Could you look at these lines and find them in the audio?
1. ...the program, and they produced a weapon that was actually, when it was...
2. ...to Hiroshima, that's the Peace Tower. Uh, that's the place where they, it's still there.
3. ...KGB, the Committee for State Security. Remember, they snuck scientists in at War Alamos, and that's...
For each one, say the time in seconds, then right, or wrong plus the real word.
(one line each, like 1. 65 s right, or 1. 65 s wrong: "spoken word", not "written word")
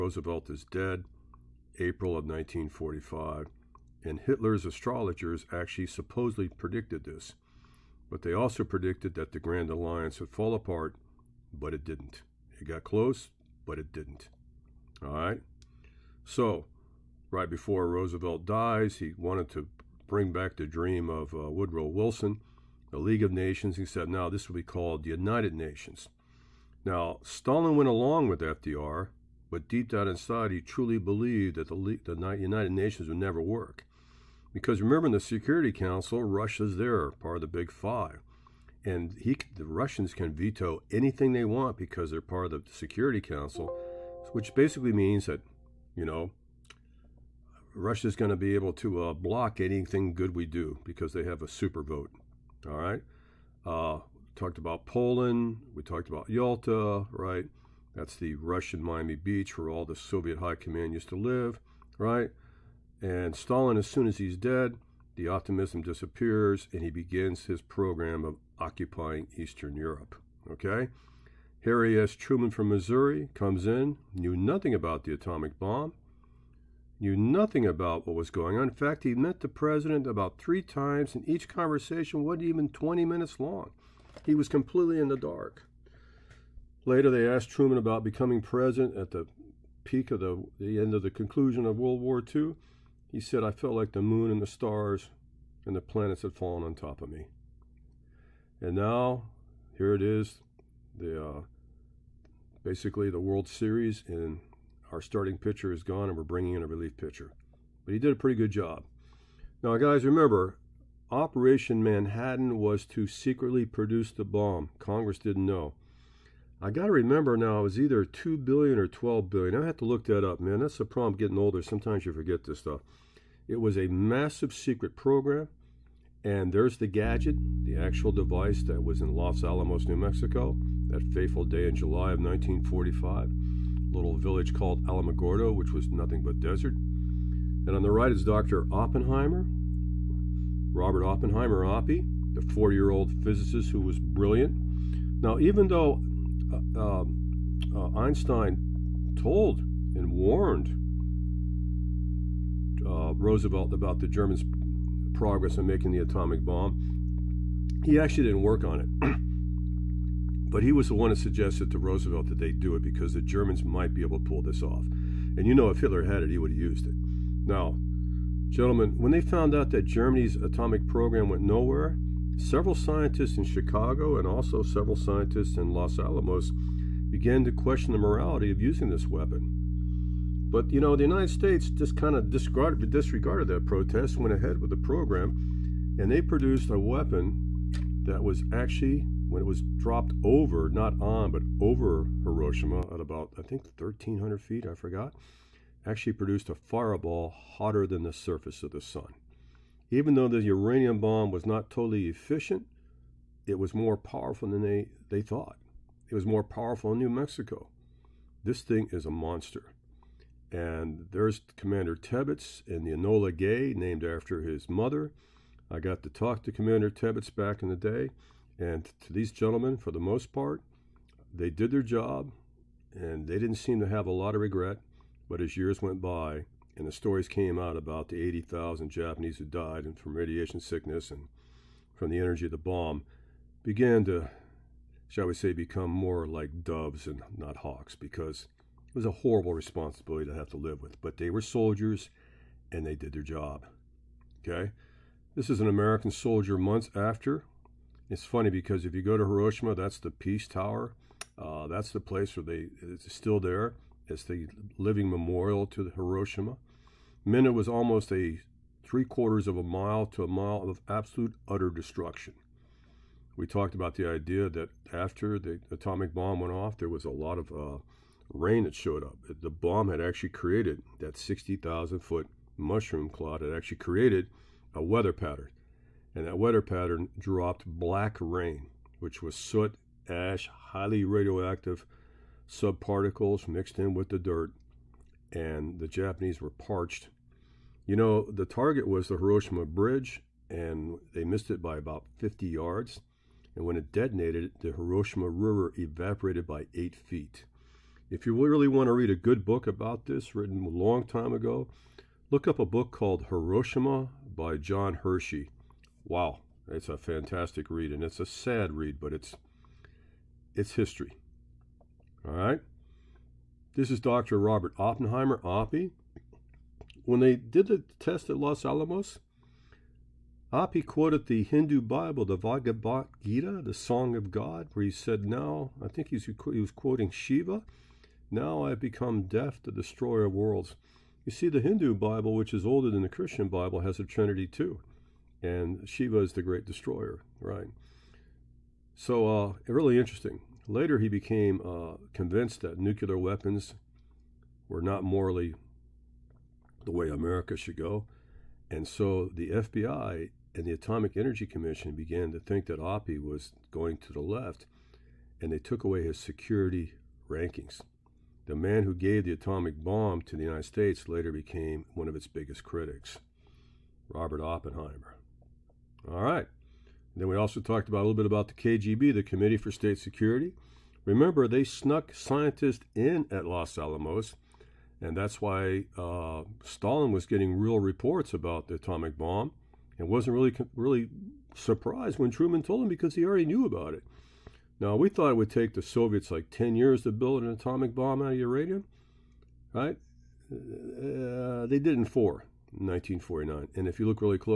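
1. 184 s right
2. 249 s right
3. 368 s wrong: "Los", not "War".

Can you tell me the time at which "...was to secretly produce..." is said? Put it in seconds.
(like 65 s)
112 s.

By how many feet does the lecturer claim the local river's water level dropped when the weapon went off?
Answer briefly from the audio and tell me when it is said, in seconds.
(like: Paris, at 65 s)
8, at 296 s.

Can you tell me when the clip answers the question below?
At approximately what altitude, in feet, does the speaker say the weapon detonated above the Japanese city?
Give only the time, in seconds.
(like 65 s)
193 s.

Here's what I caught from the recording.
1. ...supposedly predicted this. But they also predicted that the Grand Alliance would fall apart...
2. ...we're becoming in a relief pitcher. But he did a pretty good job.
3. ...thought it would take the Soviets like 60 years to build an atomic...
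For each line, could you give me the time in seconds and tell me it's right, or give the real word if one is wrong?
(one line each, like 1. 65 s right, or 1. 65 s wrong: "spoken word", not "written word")
1. 5 s right
2. 106 s wrong: "bringing", not "becoming"
3. 385 s wrong: "10", not "60".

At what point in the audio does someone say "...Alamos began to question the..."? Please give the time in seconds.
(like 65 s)
175 s.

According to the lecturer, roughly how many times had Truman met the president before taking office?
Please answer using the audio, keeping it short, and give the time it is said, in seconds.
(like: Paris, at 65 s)
3, at 80 s.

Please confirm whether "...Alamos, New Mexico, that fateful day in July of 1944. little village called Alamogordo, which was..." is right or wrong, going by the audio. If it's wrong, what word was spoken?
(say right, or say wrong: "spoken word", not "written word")
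wrong: "1945", not "1944".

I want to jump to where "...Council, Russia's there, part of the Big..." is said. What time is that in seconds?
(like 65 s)
35 s.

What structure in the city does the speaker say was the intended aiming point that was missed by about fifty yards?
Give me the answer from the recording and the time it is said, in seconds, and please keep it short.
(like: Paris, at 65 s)
Hiroshima Bridge, at 289 s.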